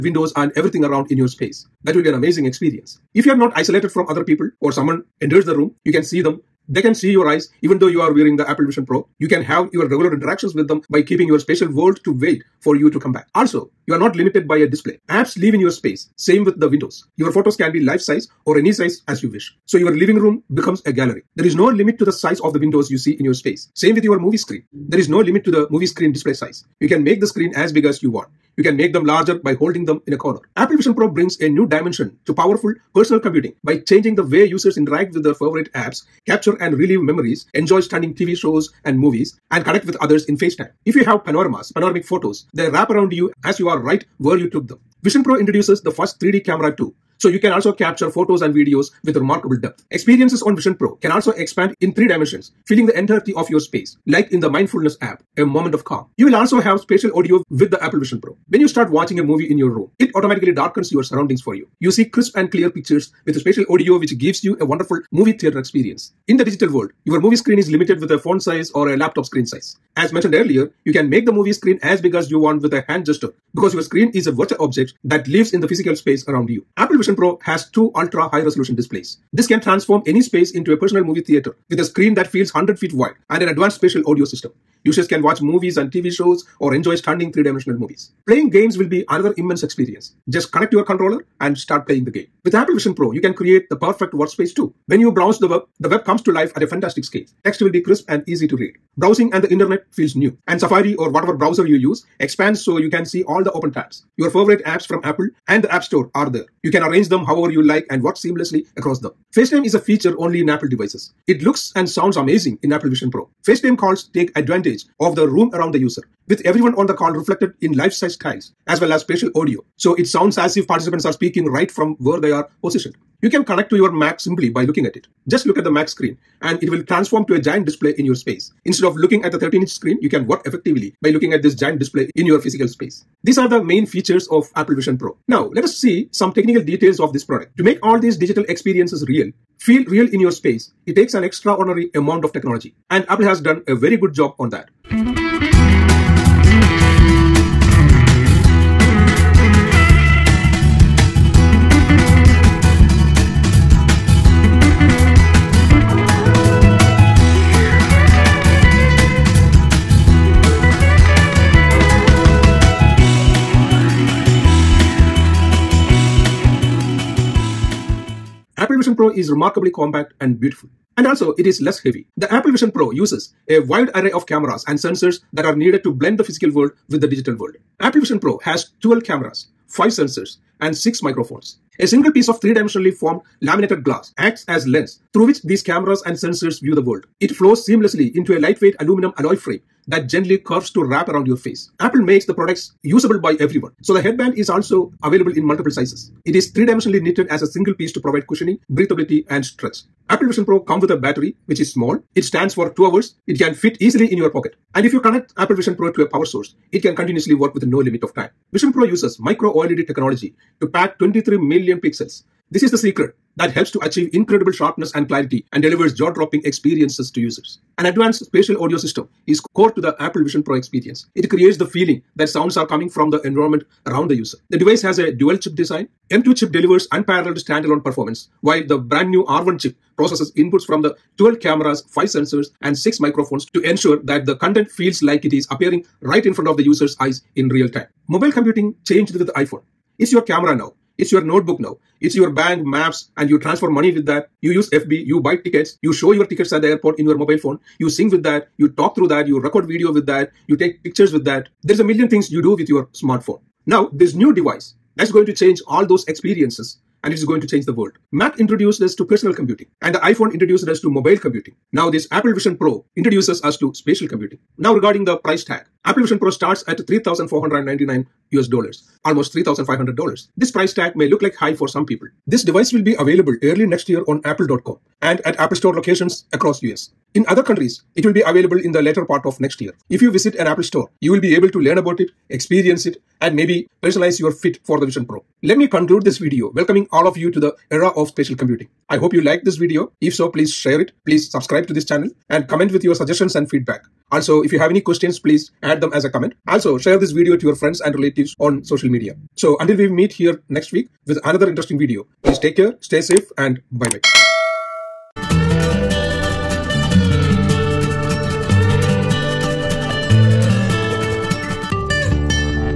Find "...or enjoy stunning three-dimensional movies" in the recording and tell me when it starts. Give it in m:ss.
1:26.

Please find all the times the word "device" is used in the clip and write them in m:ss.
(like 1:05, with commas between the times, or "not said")
1:50, 3:44, 4:14, 4:32.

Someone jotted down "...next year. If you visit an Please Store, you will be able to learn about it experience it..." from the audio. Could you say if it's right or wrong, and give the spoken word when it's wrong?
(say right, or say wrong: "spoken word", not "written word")
wrong: "Apple", not "Please".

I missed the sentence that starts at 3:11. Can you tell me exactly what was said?
Apple makes the products usable by everyone.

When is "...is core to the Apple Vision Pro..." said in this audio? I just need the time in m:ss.
3:39.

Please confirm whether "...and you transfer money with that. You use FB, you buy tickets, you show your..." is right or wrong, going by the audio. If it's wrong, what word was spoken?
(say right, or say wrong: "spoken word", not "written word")
right.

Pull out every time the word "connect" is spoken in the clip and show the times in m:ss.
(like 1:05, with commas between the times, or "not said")
0:39, 1:30, 2:03, 3:25.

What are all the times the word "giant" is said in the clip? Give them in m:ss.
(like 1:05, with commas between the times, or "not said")
2:07, 2:11.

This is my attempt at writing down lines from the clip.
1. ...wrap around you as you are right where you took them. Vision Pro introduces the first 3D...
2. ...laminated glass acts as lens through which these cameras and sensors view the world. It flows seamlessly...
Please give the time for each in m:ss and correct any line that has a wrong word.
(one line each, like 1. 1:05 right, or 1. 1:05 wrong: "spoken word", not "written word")
1. 0:42 right
2. 3:03 right.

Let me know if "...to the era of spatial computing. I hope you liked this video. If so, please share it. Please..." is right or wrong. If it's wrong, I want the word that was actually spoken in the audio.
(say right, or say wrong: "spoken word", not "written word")
right.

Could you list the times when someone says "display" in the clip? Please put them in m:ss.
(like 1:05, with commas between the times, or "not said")
0:14, 0:26, 1:18, 2:07, 2:11.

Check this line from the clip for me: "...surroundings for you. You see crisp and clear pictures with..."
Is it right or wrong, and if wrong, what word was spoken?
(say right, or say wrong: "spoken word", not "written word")
right.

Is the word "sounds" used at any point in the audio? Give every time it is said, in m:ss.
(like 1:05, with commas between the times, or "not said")
1:51, 2:00, 3:42.